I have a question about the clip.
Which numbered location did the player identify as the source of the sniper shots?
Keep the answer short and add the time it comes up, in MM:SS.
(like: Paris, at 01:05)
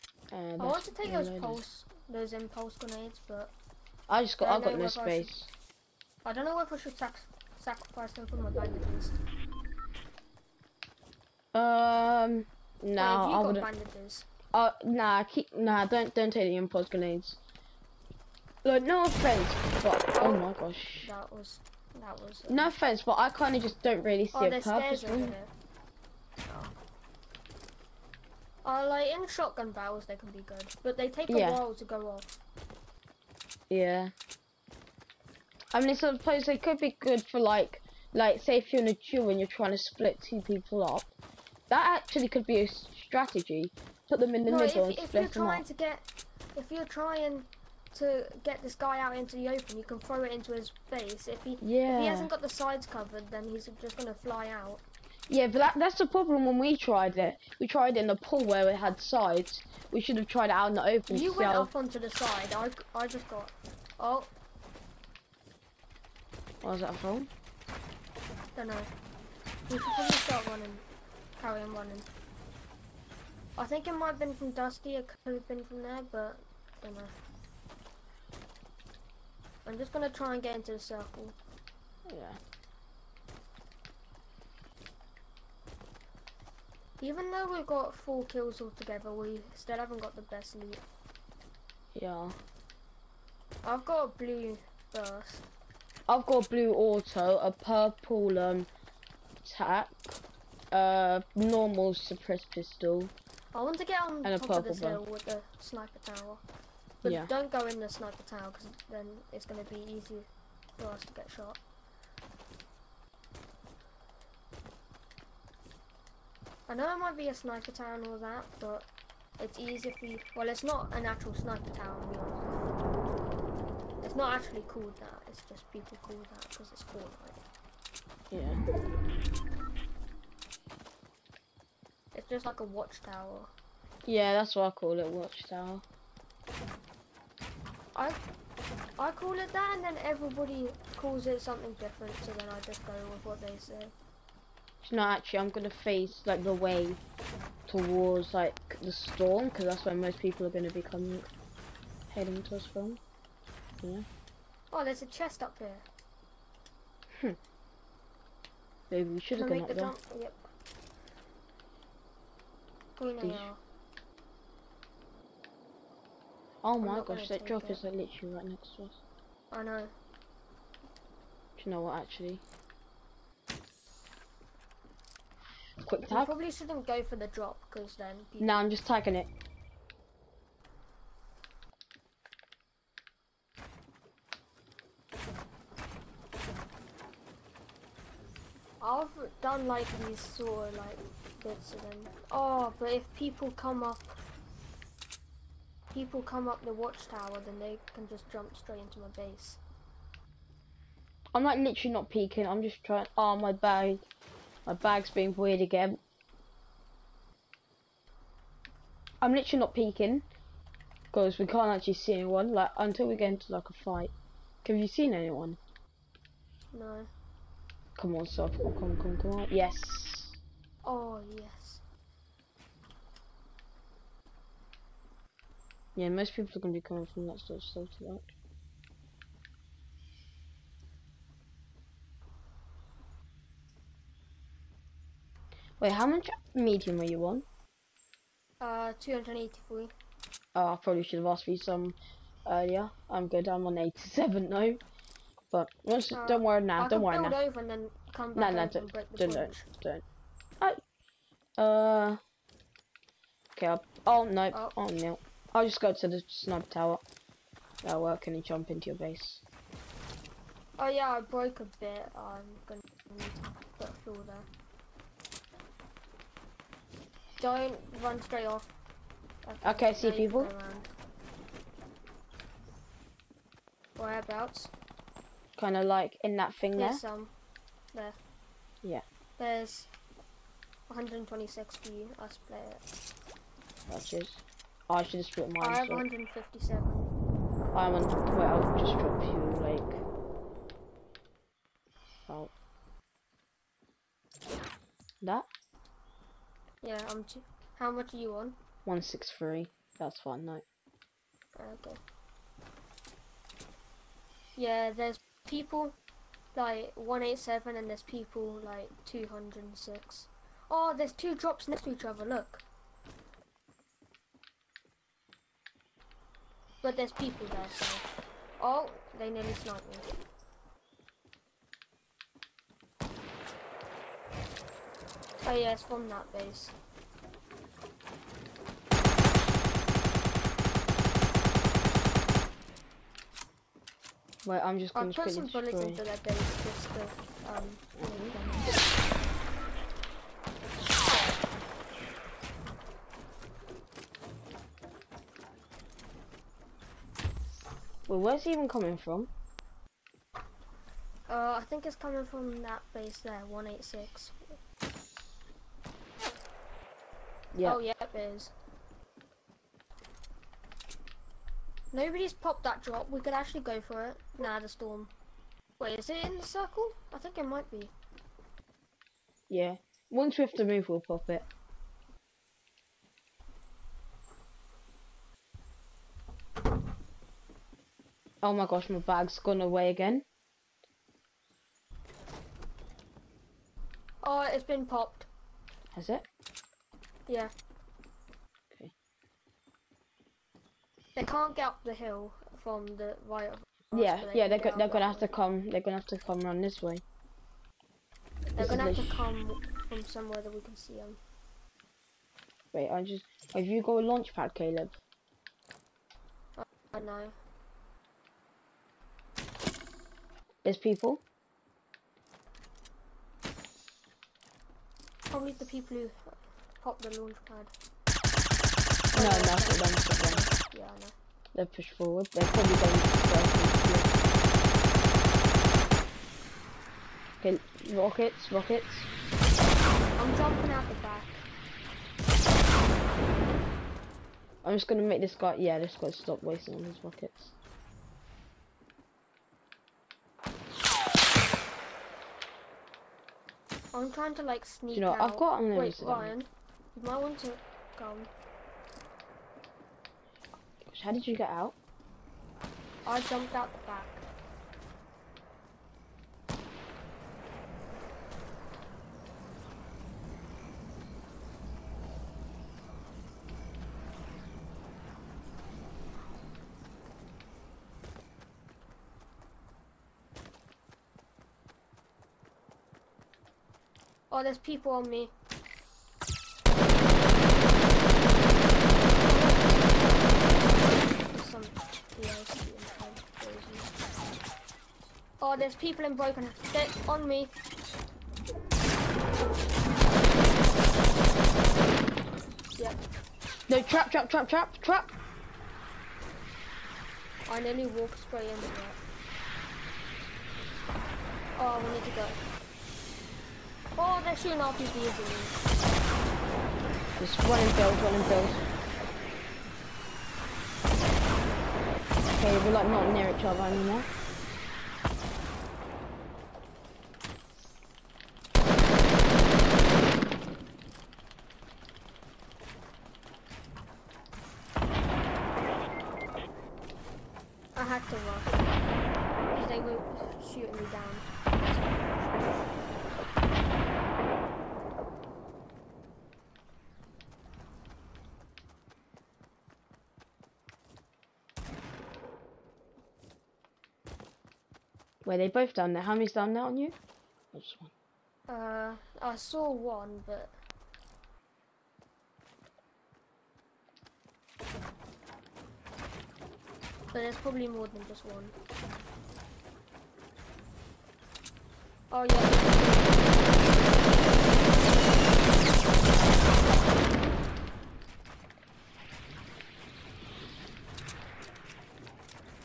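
186, at 05:53.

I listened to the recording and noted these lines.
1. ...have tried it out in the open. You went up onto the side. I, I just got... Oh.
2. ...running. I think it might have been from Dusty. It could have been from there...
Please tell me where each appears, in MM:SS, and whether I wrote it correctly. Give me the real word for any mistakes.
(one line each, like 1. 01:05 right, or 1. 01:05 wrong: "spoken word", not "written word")
1. 01:00 right
2. 01:11 right.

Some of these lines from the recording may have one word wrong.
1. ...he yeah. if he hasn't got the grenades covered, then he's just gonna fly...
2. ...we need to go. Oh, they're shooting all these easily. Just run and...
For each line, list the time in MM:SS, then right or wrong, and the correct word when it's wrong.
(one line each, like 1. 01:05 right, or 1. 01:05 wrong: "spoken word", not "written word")
1. 00:51 wrong: "sides", not "grenades"
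2. 08:21 right.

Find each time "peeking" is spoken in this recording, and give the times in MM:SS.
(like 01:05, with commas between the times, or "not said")
03:22, 03:29.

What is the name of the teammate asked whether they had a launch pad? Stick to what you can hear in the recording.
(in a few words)
Caleb.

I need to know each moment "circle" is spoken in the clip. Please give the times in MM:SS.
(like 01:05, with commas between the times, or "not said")
01:20, 06:06.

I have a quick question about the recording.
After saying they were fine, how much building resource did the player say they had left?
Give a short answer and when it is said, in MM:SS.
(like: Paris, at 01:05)
87, at 04:03.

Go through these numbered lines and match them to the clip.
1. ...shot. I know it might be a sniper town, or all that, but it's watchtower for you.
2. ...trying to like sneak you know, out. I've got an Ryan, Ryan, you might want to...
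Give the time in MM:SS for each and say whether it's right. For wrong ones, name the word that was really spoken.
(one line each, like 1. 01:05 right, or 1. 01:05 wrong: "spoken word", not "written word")
1. 01:51 wrong: "easier", not "watchtower"
2. 07:24 wrong: "Wait", not "Ryan".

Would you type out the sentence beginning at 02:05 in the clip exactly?
It's just people call that because it's that.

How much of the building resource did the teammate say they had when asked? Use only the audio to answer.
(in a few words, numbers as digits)
283.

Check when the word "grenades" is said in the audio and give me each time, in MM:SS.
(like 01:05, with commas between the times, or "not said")
00:02, 00:16.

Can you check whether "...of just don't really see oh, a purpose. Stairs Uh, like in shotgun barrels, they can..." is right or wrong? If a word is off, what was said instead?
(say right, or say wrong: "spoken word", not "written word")
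right.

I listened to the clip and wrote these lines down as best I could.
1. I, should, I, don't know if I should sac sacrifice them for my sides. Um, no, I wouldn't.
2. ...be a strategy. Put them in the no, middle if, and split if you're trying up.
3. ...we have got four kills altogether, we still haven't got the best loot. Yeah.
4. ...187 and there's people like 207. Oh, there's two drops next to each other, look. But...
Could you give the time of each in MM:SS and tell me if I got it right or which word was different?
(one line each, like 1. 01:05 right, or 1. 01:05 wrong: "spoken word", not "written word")
1. 00:05 wrong: "bandages", not "sides"
2. 00:42 right
3. 01:27 right
4. 05:06 wrong: "206", not "207".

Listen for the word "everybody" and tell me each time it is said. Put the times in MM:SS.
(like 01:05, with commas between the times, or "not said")
02:20.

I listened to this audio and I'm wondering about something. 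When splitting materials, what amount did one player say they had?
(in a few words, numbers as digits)
157.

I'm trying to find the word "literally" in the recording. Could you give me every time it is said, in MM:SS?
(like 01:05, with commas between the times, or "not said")
02:47, 03:21, 03:29.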